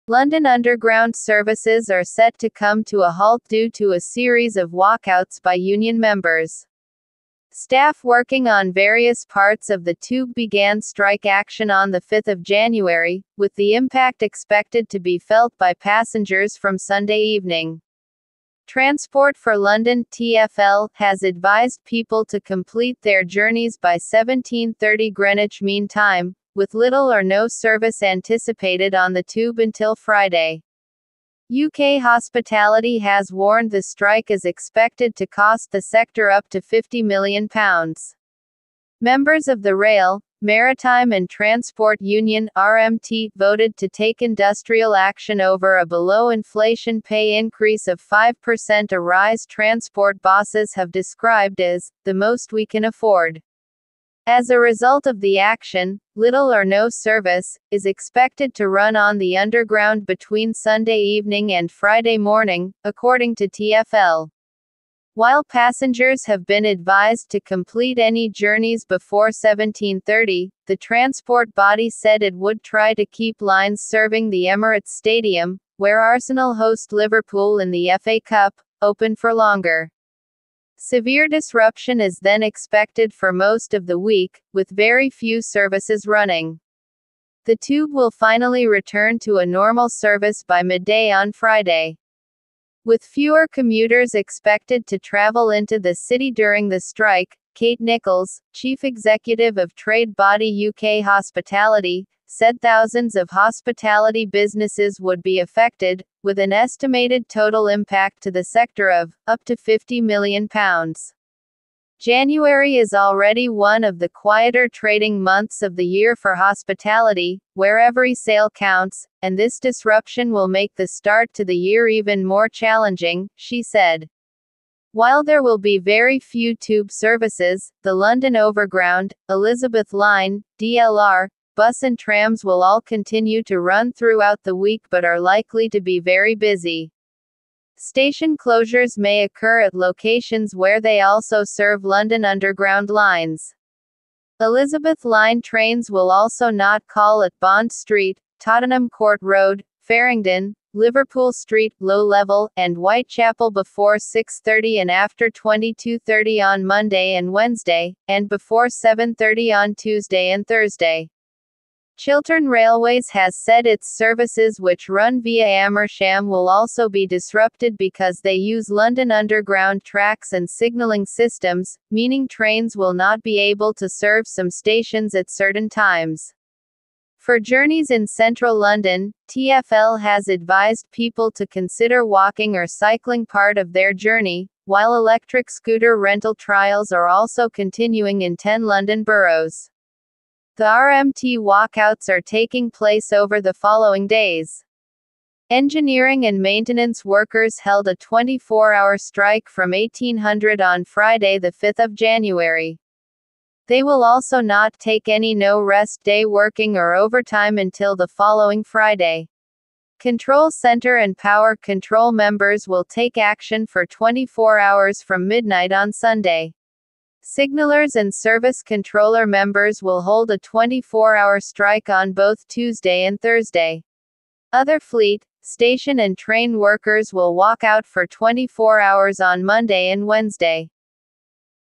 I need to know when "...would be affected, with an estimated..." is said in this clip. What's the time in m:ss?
1:45.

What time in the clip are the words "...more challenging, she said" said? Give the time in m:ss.
2:02.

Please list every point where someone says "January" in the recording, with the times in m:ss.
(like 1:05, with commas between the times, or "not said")
0:12, 1:51, 3:21.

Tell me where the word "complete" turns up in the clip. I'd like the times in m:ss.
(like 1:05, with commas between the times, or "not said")
0:22, 1:07.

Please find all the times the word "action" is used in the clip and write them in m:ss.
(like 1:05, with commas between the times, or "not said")
0:11, 0:44, 0:55, 3:33.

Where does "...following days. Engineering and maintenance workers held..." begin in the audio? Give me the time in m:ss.
3:13.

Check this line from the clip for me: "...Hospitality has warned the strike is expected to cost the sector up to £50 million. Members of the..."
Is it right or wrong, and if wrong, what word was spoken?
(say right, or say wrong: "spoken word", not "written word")
right.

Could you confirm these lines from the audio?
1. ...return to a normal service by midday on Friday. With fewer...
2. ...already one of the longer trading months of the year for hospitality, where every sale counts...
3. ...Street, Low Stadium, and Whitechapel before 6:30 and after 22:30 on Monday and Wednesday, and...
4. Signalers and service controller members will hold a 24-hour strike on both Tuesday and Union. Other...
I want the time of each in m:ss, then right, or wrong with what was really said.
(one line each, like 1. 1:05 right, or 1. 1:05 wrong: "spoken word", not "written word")
1. 1:28 right
2. 1:52 wrong: "quieter", not "longer"
3. 2:31 wrong: "Level", not "Stadium"
4. 3:37 wrong: "Thursday", not "Union".